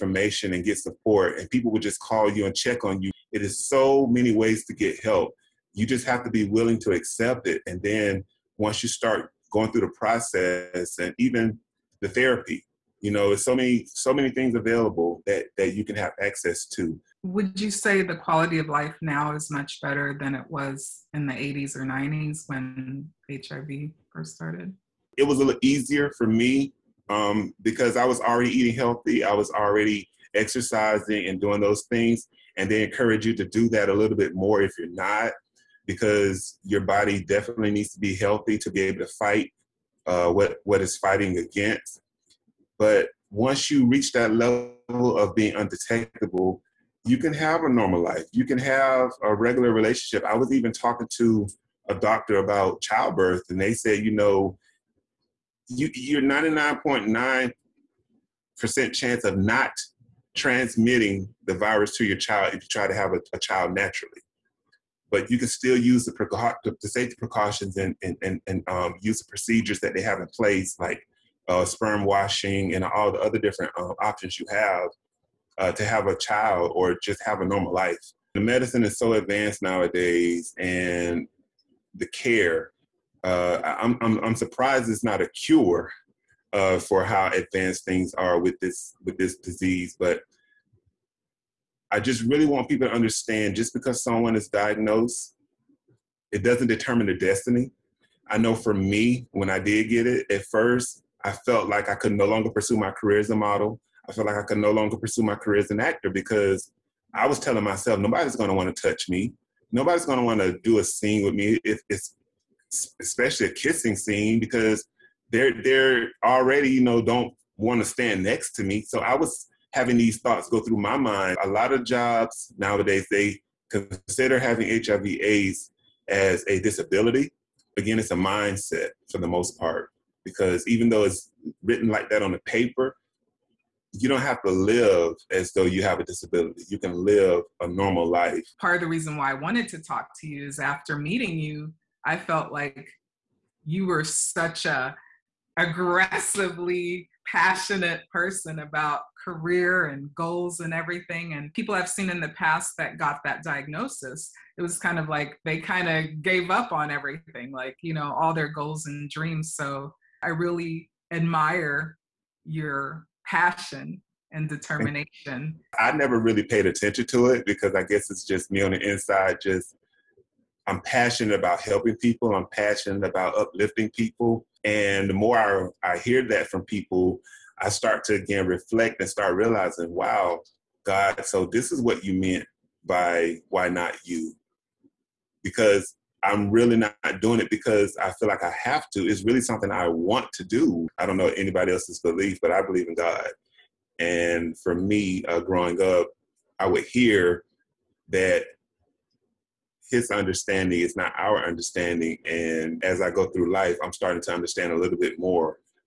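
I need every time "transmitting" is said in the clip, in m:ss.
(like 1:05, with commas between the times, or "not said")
1:00.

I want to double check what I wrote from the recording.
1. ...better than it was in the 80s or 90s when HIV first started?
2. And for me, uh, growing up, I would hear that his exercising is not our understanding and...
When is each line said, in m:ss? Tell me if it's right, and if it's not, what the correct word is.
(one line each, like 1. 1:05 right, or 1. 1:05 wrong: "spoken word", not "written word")
1. 0:19 right
2. 3:13 wrong: "understanding", not "exercising".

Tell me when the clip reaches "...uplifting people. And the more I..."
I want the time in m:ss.
2:53.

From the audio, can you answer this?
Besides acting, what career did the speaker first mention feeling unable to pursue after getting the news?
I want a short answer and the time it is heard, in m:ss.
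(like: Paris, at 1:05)
model, at 1:43.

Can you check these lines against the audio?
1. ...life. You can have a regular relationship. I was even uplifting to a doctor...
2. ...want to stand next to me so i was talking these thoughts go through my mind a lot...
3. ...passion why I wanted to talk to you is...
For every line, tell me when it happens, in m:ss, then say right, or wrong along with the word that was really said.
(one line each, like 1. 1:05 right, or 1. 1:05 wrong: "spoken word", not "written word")
1. 0:48 wrong: "talking", not "uplifting"
2. 1:57 wrong: "having", not "talking"
3. 2:18 wrong: "reason", not "passion".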